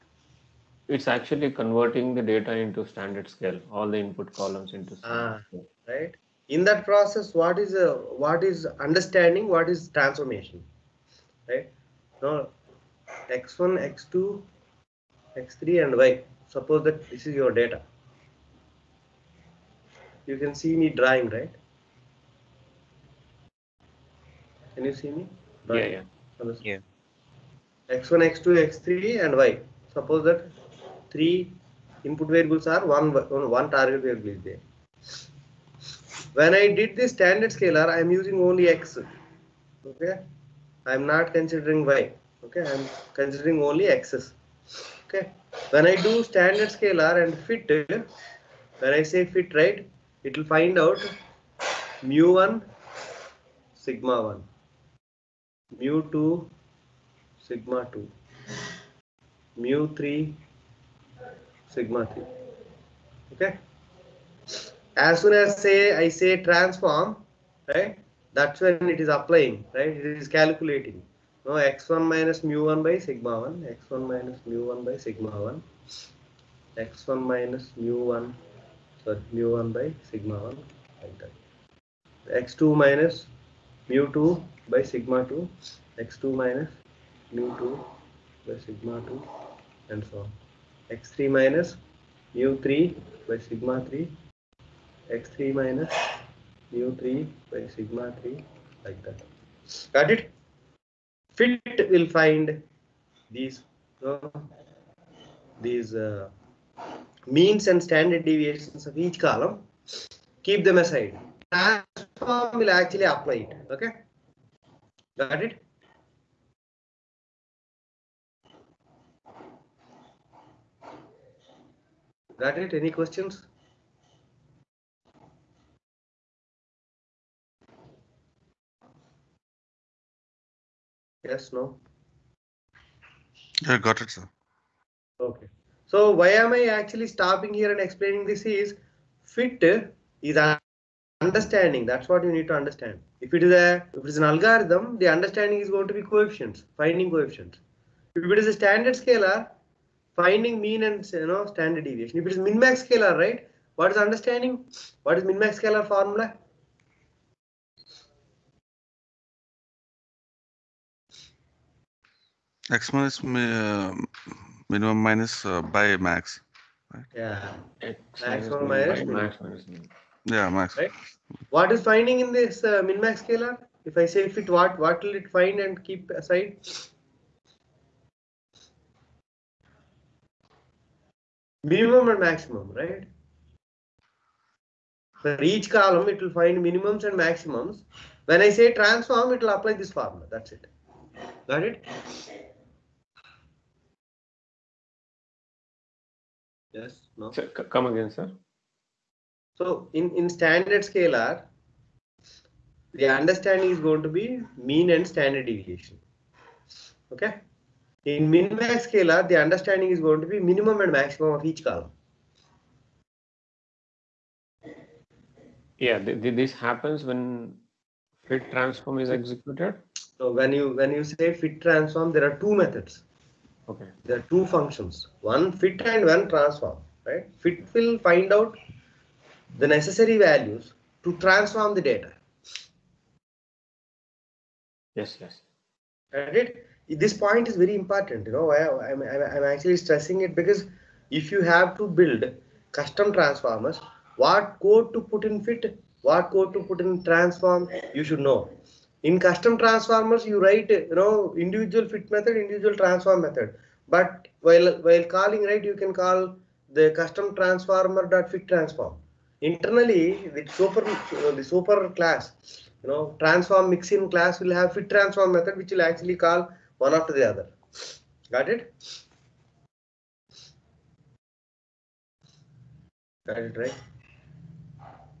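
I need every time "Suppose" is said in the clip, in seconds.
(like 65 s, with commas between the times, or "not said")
16 s, 29 s.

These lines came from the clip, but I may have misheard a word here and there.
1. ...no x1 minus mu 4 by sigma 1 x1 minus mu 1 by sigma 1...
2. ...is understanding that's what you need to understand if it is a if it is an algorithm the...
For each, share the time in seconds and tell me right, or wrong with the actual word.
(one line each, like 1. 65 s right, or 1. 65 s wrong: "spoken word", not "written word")
1. 71 s wrong: "1", not "4"
2. 140 s right.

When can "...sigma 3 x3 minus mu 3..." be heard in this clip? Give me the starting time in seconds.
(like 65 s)
93 s.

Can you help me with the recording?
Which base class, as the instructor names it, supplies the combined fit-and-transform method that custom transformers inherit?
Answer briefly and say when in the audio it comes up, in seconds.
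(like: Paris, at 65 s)
transform mixin, at 263 s.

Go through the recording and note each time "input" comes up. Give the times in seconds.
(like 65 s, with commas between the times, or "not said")
3 s, 32 s.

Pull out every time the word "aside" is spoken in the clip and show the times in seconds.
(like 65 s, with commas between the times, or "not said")
110 s, 176 s.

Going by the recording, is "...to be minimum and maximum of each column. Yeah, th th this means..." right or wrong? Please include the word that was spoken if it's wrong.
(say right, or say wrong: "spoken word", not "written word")
wrong: "happens", not "means".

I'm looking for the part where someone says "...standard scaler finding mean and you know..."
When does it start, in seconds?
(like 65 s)
148 s.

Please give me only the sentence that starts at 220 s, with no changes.
So when you when you say fit transform, there are two methods.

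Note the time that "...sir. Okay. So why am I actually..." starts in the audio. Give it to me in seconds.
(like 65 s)
134 s.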